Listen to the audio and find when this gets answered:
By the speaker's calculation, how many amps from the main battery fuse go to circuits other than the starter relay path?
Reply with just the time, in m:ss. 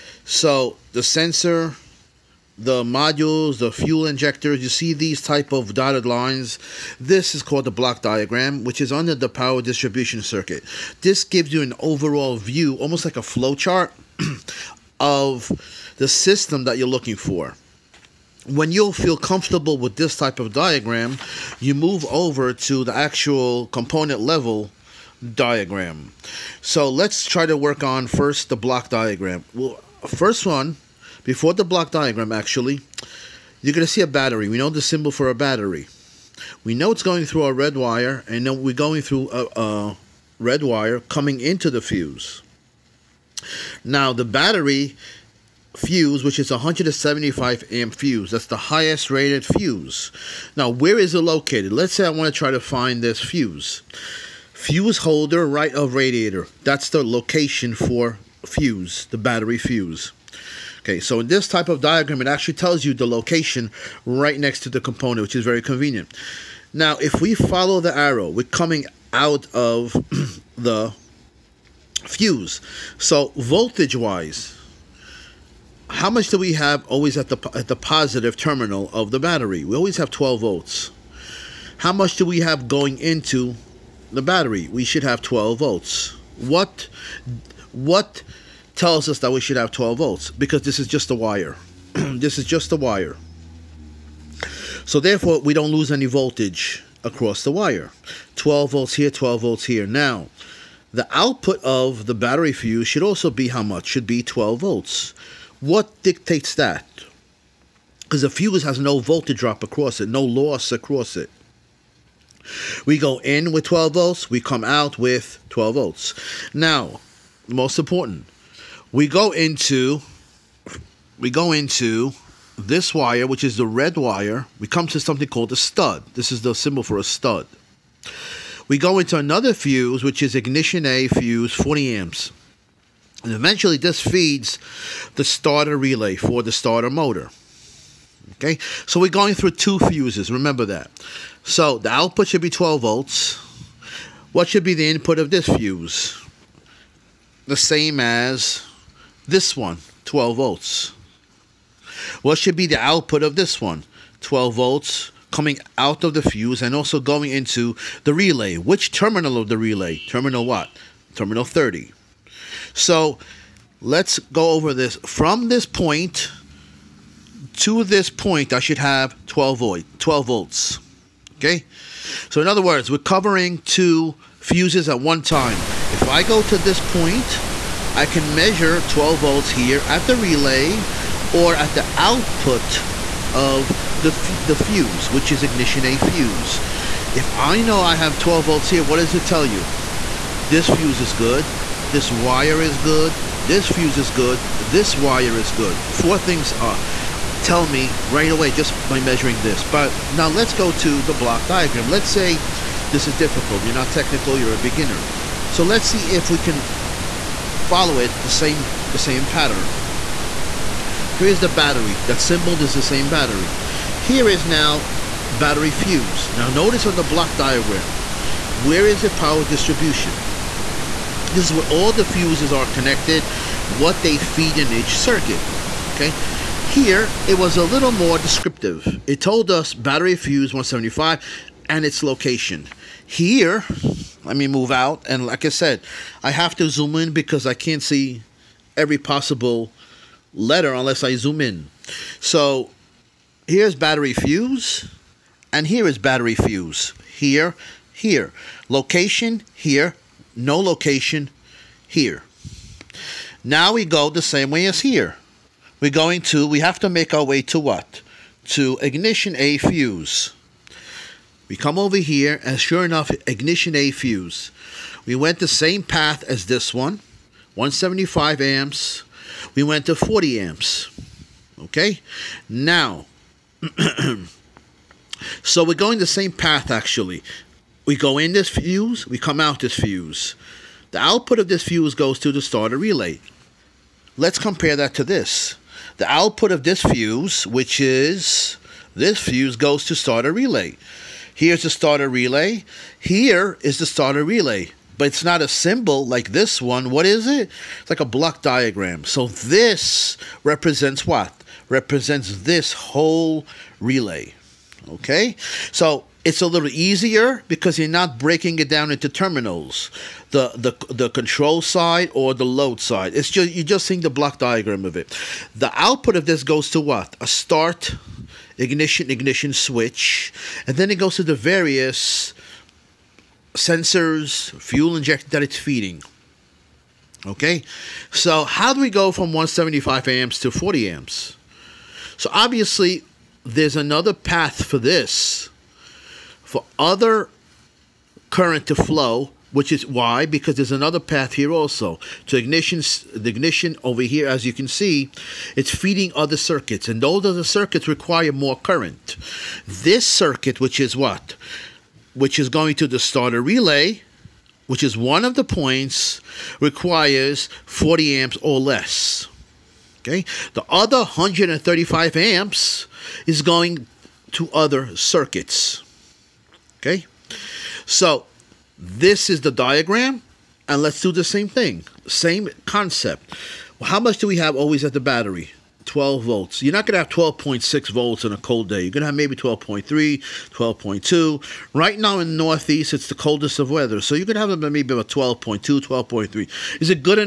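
6:00.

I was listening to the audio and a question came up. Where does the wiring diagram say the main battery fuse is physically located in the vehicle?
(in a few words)
Fuse holder, right of radiator.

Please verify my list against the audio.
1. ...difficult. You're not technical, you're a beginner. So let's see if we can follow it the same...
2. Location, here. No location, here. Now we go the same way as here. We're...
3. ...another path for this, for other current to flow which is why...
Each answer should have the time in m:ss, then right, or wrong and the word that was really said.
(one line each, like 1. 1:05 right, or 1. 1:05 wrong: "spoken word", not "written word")
1. 3:23 right
2. 4:08 right
3. 5:33 right.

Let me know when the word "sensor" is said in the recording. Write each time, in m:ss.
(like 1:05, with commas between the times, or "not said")
0:01, 5:23.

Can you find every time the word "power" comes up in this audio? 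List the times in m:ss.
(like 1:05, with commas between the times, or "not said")
0:09, 3:39.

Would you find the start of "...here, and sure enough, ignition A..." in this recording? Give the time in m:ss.
4:21.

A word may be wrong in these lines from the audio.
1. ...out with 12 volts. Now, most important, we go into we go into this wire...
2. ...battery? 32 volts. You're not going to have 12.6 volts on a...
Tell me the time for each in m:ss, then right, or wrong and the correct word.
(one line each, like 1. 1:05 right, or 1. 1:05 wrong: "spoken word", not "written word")
1. 1:54 right
2. 6:15 wrong: "12", not "32".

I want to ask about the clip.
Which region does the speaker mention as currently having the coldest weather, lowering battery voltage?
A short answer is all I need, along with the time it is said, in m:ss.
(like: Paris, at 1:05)
Northeast, at 6:22.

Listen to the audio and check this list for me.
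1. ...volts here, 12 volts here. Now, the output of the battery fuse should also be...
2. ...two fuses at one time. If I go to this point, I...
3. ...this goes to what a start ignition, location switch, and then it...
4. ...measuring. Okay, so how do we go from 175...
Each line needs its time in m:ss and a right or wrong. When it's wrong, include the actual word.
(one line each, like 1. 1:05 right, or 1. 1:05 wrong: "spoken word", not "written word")
1. 1:38 right
2. 2:53 right
3. 5:16 wrong: "ignition", not "location"
4. 5:25 wrong: "feeding", not "measuring".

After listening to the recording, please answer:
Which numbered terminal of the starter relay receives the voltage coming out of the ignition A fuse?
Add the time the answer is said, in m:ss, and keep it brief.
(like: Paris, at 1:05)
Terminal 30, at 2:41.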